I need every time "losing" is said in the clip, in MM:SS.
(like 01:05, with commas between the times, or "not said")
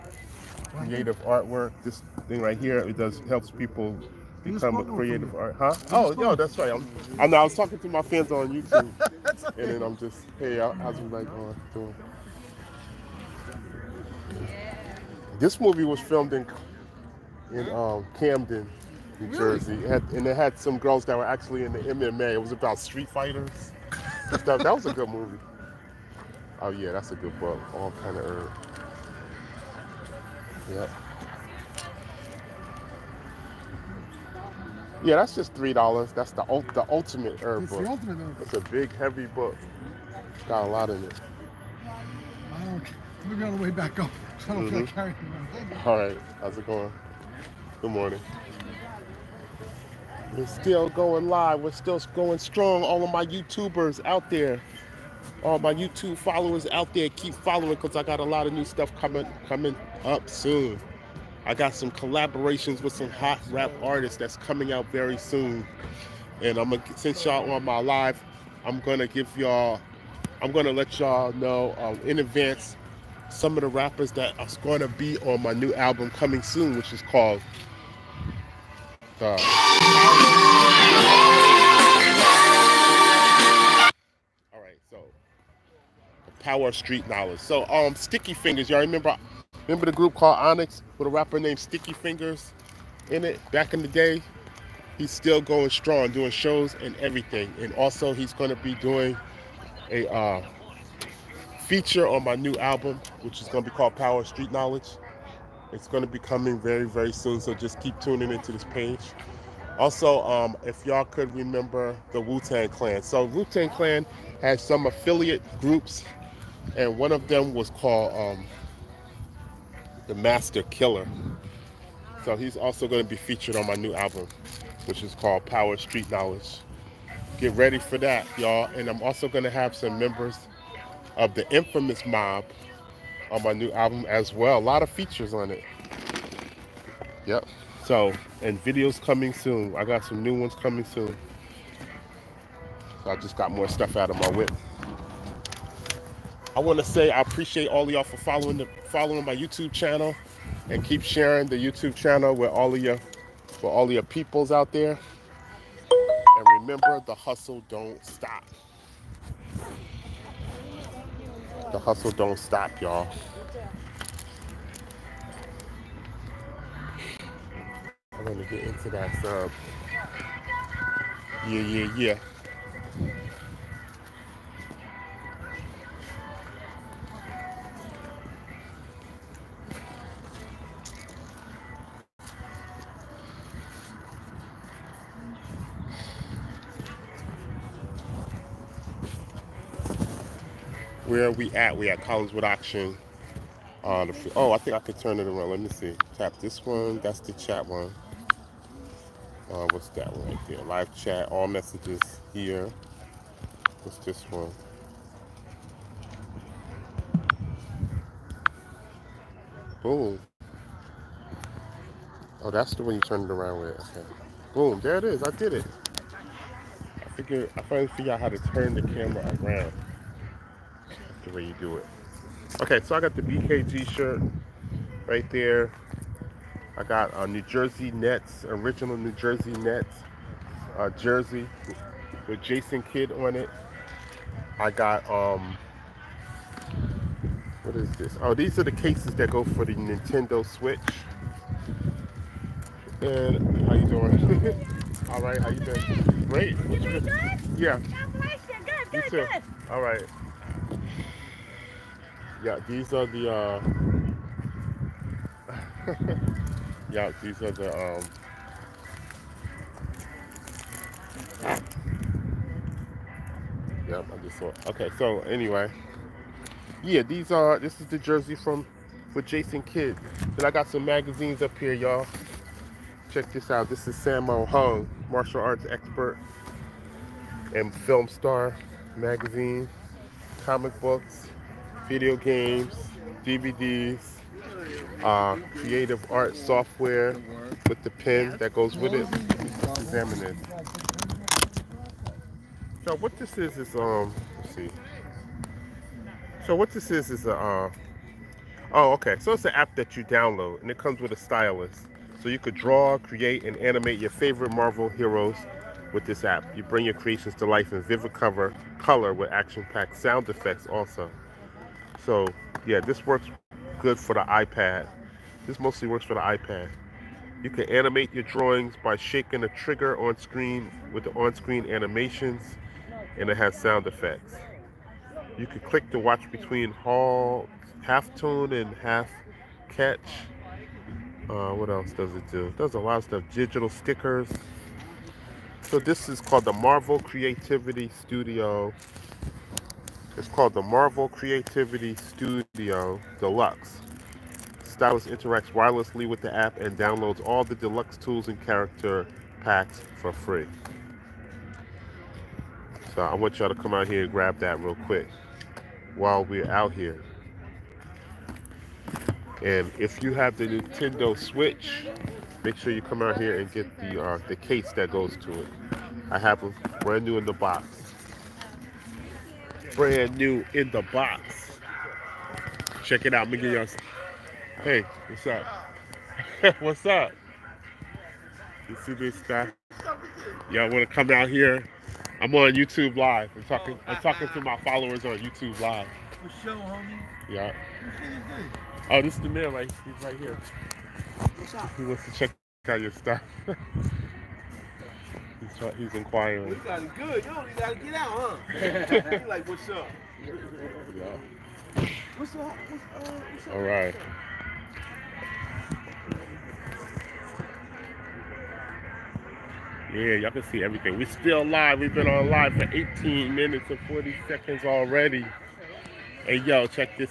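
not said.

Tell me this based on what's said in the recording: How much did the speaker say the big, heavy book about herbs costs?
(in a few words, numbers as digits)
$3.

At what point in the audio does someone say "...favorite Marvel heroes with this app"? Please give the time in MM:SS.
05:04.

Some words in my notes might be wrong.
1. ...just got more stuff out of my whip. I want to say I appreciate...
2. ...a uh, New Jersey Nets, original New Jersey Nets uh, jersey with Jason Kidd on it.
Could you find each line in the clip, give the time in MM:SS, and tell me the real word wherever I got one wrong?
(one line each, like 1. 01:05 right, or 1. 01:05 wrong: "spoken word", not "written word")
1. 02:23 right
2. 03:47 right.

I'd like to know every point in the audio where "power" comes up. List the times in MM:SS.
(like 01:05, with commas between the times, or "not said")
01:26, 01:43, 02:05.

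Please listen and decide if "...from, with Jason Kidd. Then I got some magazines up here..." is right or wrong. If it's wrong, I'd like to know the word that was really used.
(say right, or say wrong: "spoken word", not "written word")
right.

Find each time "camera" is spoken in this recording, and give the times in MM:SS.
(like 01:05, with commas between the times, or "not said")
03:38.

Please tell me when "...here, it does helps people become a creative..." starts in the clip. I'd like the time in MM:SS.
00:02.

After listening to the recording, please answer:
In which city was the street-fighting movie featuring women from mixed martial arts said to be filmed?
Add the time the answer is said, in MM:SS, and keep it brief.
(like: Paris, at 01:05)
Camden, at 00:18.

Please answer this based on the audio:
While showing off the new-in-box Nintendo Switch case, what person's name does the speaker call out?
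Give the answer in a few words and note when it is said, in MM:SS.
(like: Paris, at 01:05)
Miguel, at 06:13.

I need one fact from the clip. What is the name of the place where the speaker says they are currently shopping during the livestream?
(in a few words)
Collingwood Auction.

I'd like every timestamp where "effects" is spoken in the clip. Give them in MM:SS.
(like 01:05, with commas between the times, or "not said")
05:10, 05:23.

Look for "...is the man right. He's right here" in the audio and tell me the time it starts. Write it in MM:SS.
06:29.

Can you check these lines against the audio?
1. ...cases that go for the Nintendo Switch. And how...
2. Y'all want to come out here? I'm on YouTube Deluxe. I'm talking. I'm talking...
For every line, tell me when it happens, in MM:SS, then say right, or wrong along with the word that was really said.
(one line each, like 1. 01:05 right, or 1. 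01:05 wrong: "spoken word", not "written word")
1. 03:58 right
2. 06:20 wrong: "Live", not "Deluxe".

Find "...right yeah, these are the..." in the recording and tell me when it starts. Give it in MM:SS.
04:09.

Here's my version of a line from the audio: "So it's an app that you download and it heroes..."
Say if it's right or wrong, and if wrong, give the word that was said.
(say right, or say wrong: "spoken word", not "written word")
wrong: "comes", not "heroes".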